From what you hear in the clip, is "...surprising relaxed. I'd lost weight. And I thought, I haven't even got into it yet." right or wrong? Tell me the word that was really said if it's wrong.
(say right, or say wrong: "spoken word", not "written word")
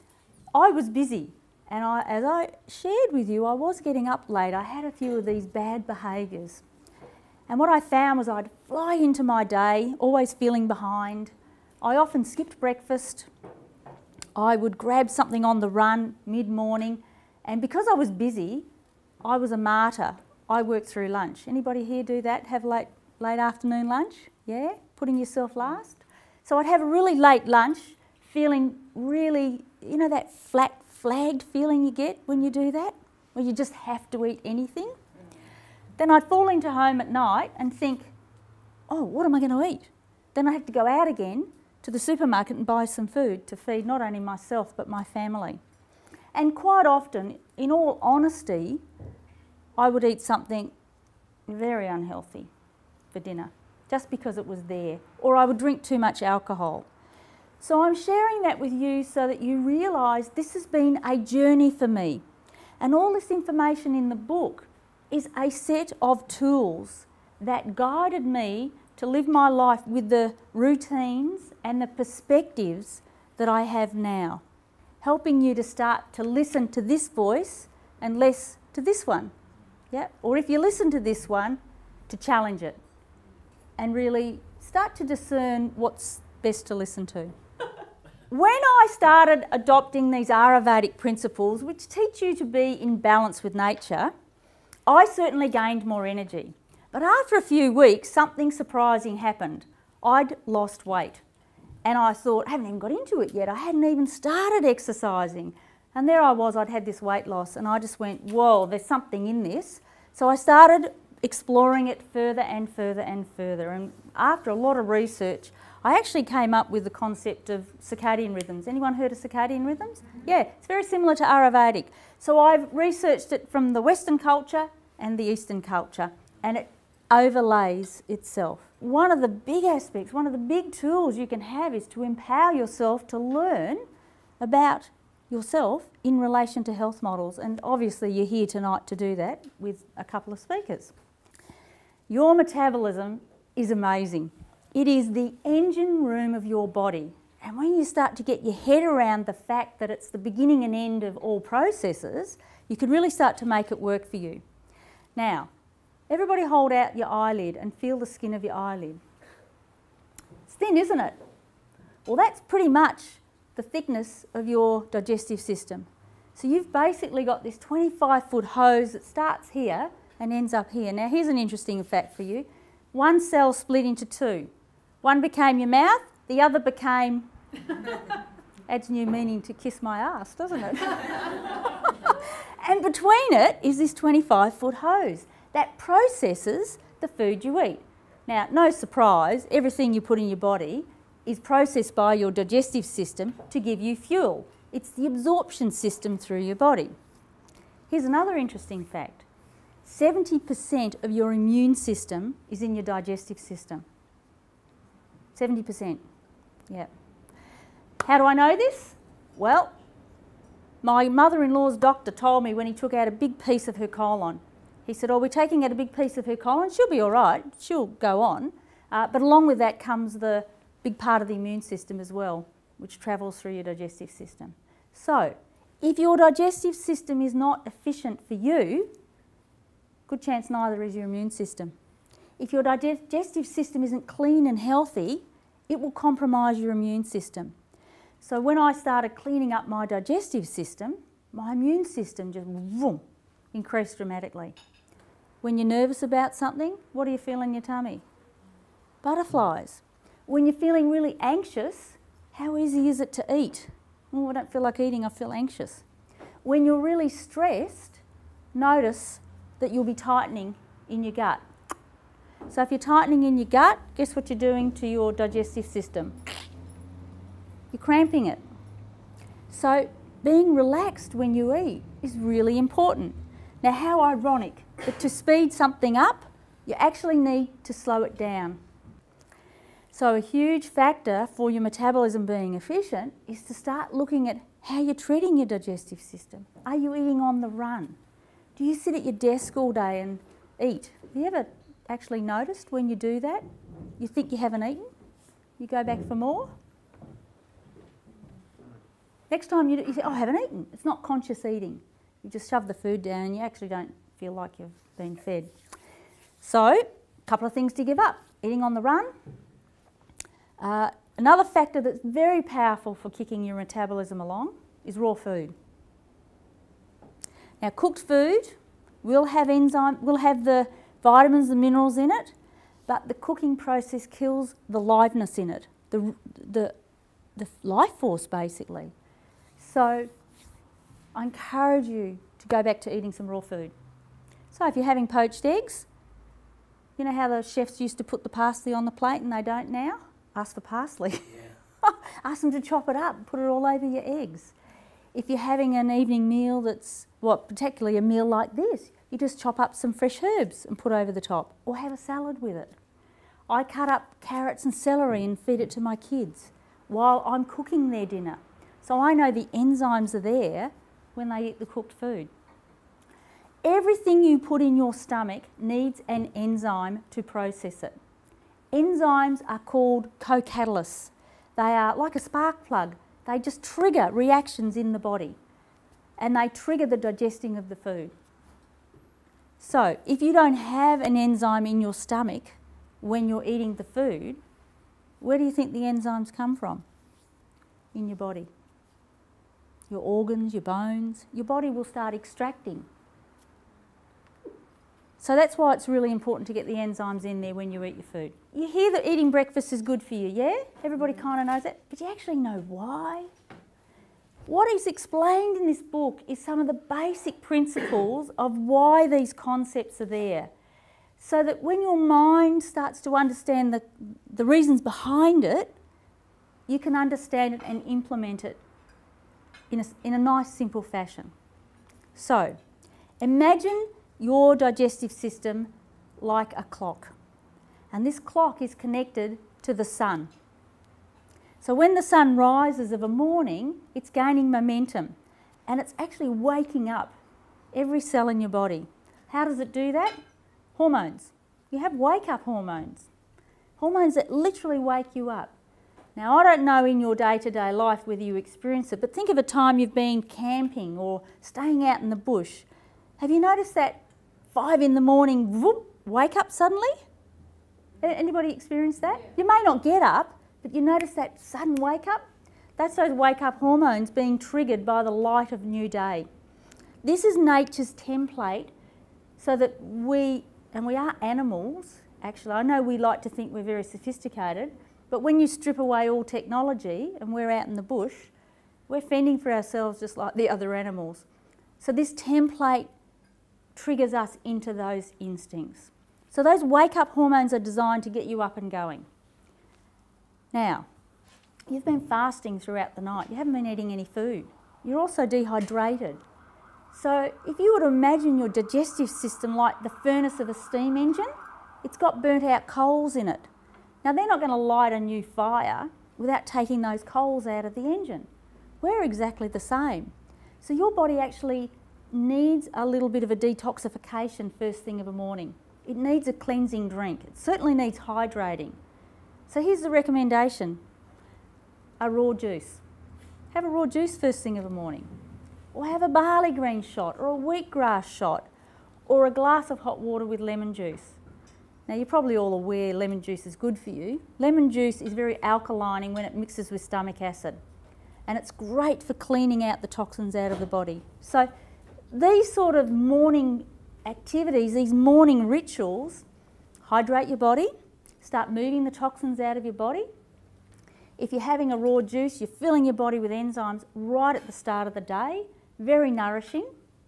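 wrong: "happened", not "relaxed".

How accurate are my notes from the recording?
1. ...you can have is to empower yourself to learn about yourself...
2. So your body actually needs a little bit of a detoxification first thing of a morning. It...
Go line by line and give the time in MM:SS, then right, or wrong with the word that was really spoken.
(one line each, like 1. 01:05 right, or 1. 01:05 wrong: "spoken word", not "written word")
1. 02:11 right
2. 08:30 right.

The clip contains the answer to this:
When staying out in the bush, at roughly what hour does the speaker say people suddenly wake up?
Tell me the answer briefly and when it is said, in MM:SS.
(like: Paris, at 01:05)
5 in the morning, at 07:34.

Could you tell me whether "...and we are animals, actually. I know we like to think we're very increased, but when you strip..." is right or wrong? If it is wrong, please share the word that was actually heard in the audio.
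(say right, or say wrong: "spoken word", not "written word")
wrong: "sophisticated", not "increased".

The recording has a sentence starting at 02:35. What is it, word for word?
Now, Everybody hold out your eyelid and feel the skin of your eyelid.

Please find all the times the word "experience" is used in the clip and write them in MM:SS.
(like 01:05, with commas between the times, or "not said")
07:28, 07:38.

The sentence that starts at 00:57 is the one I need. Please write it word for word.
So I'm sharing that with you so that you realise this has been a journey for me.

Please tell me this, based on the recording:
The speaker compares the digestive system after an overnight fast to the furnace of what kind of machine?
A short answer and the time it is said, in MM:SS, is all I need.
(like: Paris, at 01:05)
Steam engine, at 08:20.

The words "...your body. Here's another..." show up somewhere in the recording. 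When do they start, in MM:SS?
03:16.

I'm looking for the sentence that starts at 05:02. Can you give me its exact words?
You just shove the food down and you actually don't feel like you've been fed.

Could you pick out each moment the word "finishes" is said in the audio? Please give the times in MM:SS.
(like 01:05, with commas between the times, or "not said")
not said.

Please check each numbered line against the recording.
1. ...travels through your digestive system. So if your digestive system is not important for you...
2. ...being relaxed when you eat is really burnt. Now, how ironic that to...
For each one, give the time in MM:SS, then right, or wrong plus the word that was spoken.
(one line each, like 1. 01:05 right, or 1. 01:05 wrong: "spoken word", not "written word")
1. 03:42 wrong: "efficient", not "important"
2. 04:30 wrong: "important", not "burnt".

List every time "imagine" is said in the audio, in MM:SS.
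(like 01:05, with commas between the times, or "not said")
07:03, 08:17.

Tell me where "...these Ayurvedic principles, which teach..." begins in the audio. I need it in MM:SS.
01:30.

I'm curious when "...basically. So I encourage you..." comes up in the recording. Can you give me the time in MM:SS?
05:28.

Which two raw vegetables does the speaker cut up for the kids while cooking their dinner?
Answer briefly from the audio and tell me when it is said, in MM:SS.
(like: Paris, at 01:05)
Carrots and celery, at 05:54.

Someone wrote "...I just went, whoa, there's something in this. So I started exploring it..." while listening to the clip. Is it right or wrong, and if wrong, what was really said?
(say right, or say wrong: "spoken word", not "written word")
right.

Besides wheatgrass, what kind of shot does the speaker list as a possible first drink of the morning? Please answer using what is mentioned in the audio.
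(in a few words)
Barley green.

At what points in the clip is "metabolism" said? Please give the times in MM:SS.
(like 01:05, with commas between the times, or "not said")
02:22, 04:41, 05:13.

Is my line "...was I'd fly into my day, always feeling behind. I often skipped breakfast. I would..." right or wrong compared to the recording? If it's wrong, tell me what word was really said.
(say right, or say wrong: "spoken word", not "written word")
right.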